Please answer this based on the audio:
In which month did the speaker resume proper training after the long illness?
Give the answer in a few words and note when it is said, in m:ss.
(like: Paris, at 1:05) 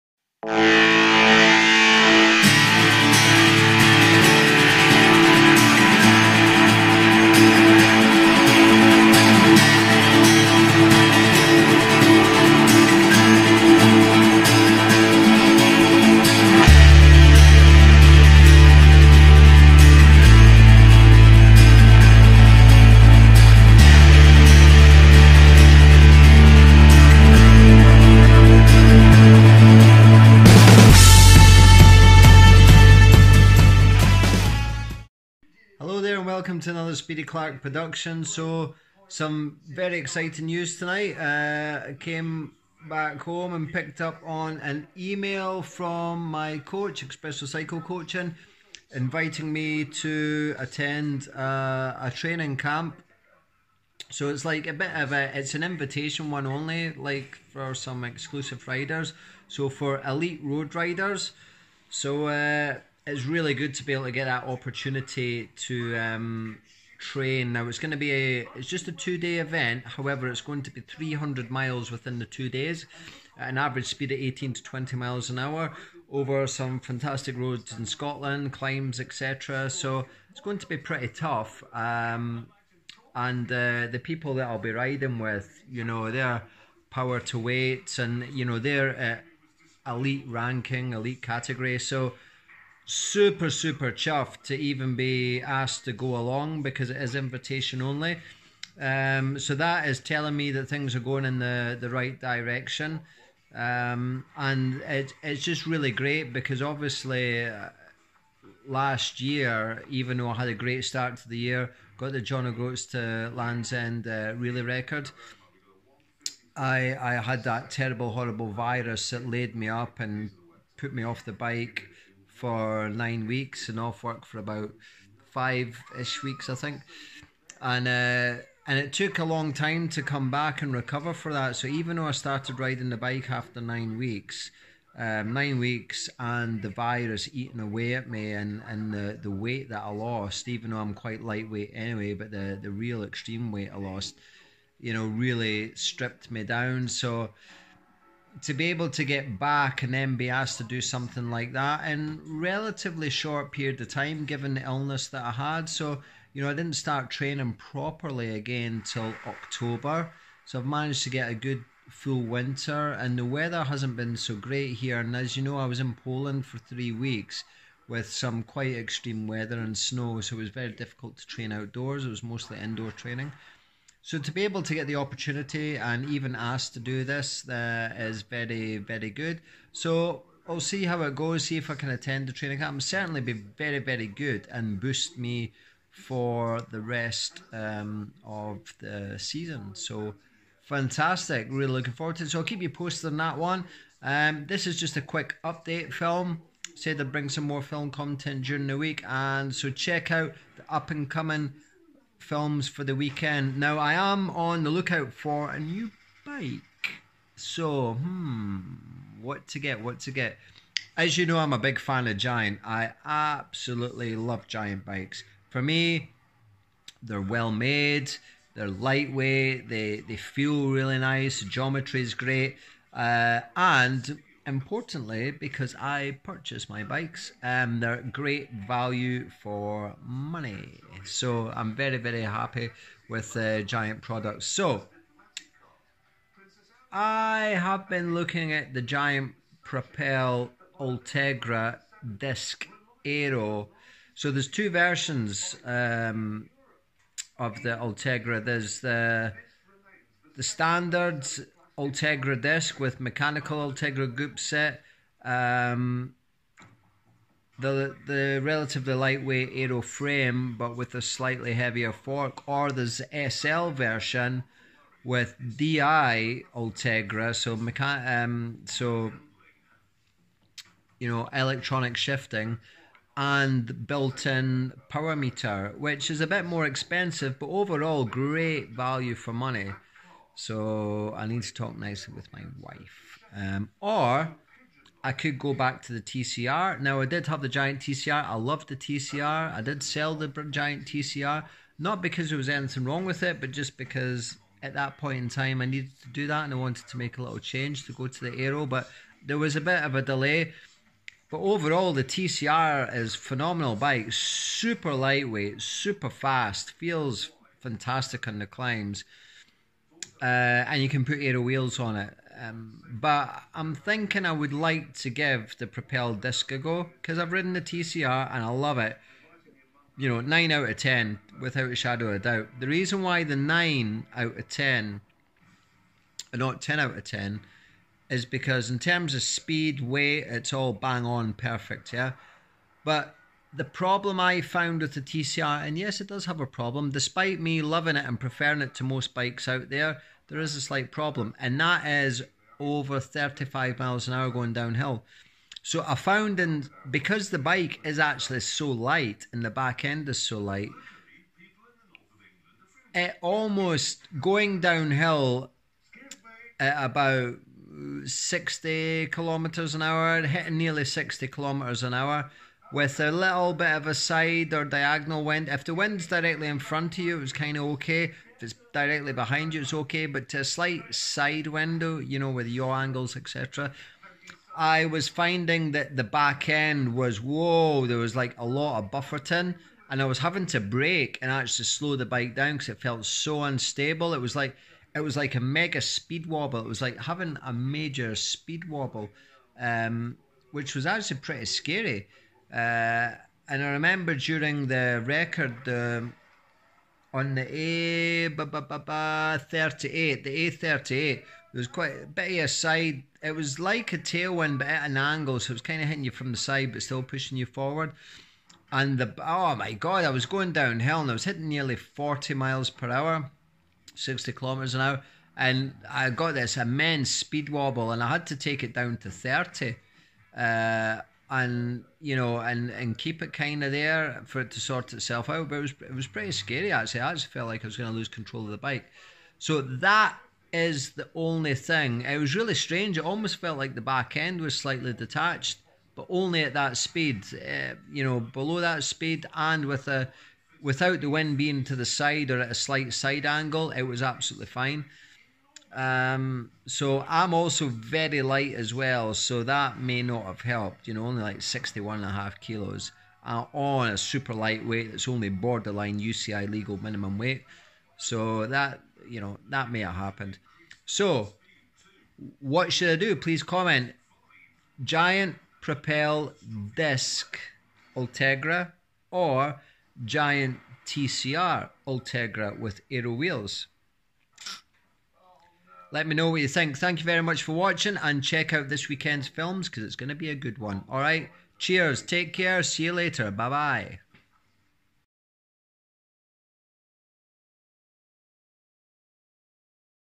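October, at 2:39.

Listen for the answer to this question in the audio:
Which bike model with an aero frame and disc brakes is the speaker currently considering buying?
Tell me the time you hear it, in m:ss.
3:58.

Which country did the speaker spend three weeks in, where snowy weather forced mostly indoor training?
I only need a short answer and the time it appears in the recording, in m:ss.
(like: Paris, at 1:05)
Poland, at 2:46.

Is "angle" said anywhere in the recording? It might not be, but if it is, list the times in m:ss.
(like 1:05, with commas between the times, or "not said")
6:12, 6:44, 7:23.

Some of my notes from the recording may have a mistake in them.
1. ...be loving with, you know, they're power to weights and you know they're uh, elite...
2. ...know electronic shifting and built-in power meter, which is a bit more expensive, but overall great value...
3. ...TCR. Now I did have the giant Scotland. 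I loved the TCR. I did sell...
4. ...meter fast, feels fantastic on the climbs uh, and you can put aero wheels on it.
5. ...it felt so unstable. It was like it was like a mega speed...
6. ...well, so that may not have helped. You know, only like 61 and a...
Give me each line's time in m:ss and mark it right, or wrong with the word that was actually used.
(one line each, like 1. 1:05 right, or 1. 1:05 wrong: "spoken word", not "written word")
1. 1:24 wrong: "riding", not "loving"
2. 4:31 right
3. 4:46 wrong: "TCR", not "Scotland"
4. 5:05 wrong: "super", not "meter"
5. 6:22 right
6. 7:28 right.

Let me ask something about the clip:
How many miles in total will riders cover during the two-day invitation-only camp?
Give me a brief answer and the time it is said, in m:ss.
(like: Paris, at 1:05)
300, at 1:10.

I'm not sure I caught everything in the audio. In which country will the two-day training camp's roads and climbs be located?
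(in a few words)
Scotland.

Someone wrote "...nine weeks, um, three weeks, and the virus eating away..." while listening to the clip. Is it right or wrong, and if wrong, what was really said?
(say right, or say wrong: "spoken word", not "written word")
wrong: "nine", not "three".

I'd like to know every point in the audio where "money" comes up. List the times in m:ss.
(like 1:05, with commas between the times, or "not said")
3:50, 4:39.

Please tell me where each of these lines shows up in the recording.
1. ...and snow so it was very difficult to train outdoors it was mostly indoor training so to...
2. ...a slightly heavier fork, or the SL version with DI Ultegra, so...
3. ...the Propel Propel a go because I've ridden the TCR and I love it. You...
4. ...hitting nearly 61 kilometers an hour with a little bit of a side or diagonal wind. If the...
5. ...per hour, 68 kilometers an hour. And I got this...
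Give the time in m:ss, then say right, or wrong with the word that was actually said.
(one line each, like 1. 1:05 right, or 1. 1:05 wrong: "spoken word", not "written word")
1. 2:49 right
2. 4:20 right
3. 5:15 wrong: "Disc", not "Propel"
4. 6:00 wrong: "60", not "61"
5. 6:52 wrong: "60", not "68".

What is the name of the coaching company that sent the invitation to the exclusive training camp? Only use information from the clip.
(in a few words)
Expresso Cycle Coaching.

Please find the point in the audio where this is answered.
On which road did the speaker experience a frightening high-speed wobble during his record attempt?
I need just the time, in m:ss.
6:40.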